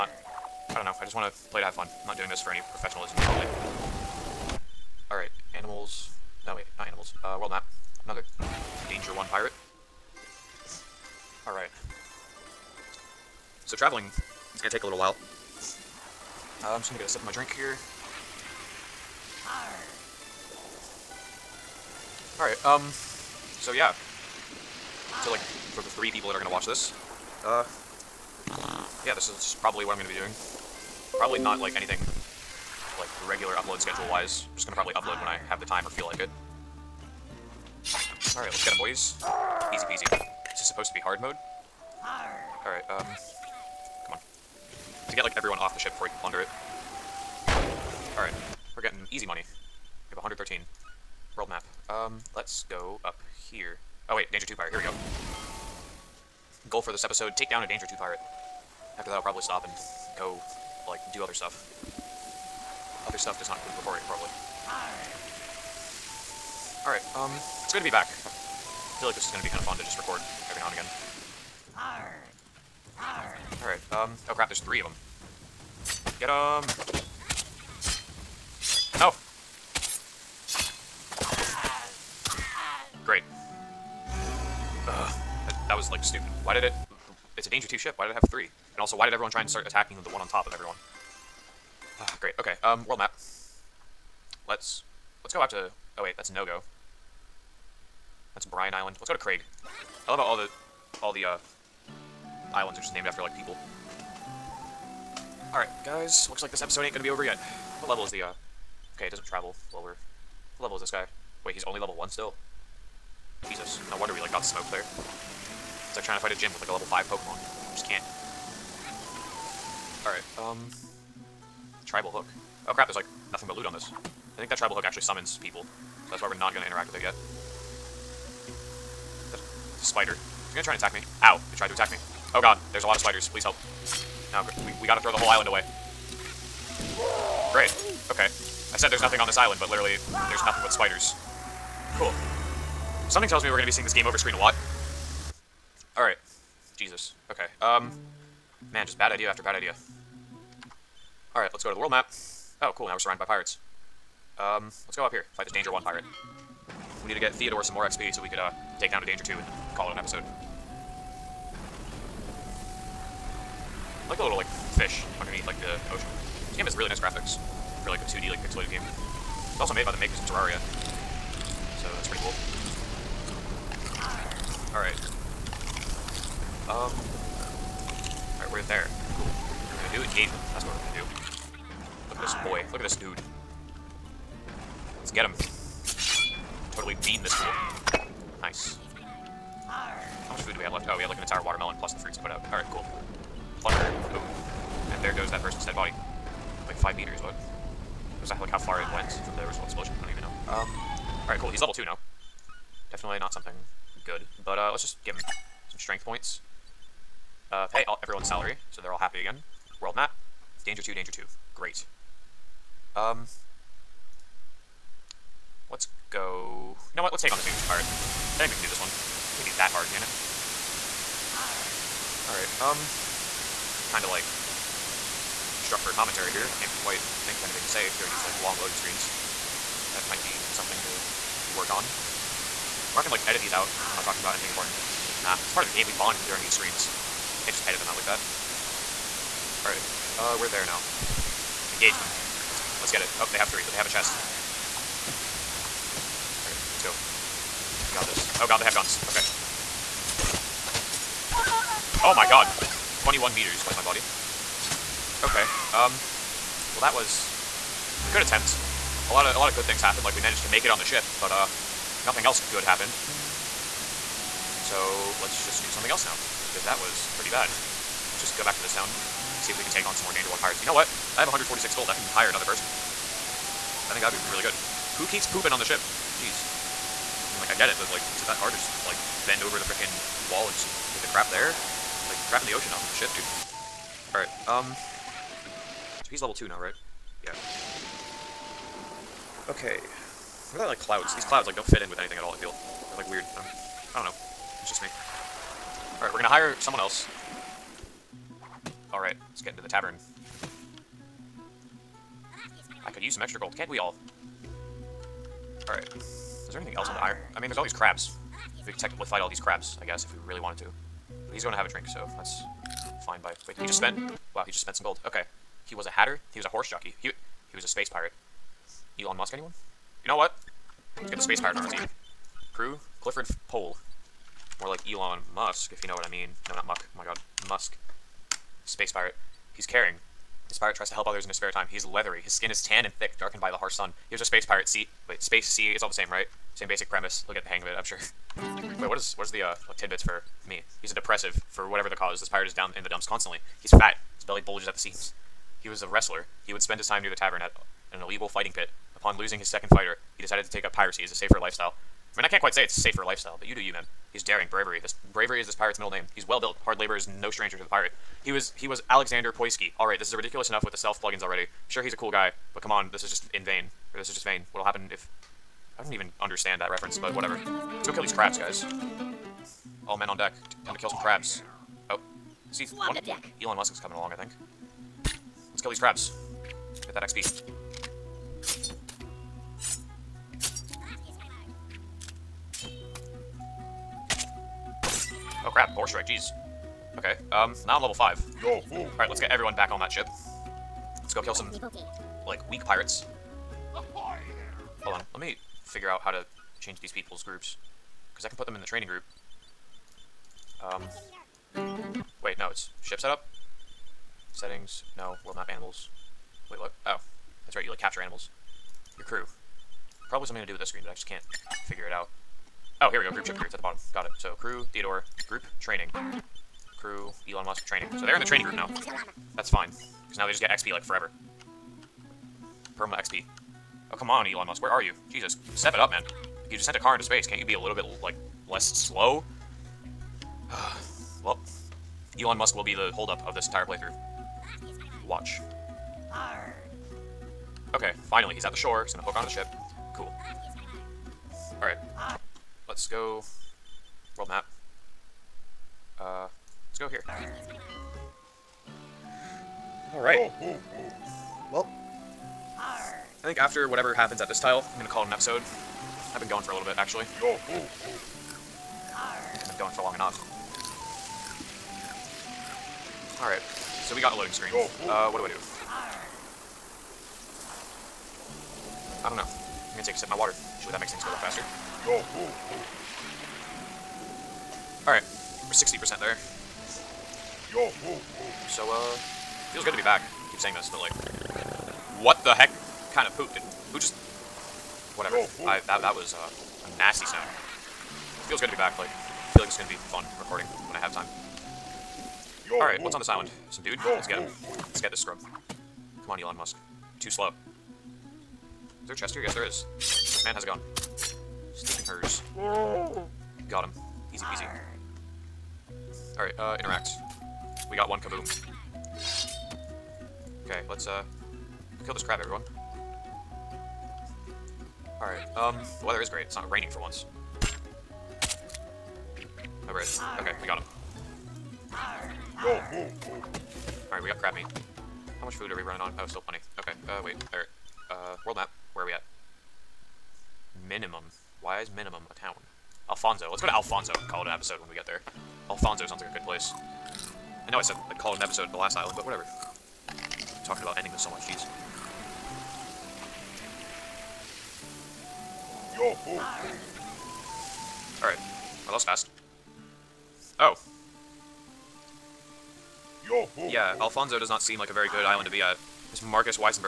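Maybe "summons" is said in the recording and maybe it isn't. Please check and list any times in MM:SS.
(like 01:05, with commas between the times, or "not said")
02:05.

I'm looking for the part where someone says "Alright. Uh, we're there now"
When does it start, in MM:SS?
03:59.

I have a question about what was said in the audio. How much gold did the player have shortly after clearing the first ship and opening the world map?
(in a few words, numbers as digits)
113.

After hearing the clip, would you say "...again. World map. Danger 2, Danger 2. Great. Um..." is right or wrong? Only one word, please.
right.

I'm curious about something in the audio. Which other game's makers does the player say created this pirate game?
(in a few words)
Terraria.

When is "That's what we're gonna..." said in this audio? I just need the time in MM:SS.
03:00.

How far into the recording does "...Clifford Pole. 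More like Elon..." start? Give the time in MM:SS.
05:23.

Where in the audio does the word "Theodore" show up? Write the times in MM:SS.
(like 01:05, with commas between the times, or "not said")
02:37, 06:54.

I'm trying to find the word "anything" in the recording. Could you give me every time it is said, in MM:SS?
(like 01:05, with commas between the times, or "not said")
00:31, 03:47, 03:54, 04:51, 05:06.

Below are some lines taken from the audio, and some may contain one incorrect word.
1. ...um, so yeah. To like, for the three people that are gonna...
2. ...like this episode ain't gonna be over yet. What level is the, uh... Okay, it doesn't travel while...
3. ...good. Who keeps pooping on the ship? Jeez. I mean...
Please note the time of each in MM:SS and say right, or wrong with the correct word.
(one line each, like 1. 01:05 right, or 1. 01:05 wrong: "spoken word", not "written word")
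1. 00:22 right
2. 01:46 right
3. 04:34 right.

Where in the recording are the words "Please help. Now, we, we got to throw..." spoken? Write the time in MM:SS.
02:13.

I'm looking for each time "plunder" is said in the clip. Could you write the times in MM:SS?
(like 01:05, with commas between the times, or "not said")
00:46.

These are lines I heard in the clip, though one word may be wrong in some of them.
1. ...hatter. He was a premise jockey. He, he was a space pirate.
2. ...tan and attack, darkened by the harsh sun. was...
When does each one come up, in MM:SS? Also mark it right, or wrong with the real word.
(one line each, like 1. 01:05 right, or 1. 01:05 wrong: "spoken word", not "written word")
1. 05:15 wrong: "horse", not "premise"
2. 05:32 wrong: "thick", not "attack".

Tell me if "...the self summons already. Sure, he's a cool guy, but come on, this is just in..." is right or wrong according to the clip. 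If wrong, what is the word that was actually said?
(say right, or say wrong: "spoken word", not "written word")
wrong: "plugins", not "summons".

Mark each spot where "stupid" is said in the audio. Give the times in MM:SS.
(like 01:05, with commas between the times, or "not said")
01:26.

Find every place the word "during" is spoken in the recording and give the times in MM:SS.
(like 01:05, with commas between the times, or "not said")
03:47, 03:56.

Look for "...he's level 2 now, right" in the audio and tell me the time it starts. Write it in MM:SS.
04:46.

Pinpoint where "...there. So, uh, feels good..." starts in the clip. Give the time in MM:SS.
07:55.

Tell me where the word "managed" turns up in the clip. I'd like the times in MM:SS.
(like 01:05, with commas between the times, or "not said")
04:20.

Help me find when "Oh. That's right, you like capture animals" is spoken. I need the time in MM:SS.
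06:46.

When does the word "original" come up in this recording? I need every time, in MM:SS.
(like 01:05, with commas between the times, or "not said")
03:19.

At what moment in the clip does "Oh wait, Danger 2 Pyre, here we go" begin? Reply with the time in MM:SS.
00:54.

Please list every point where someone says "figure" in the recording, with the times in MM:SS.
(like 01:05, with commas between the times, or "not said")
06:35, 06:51.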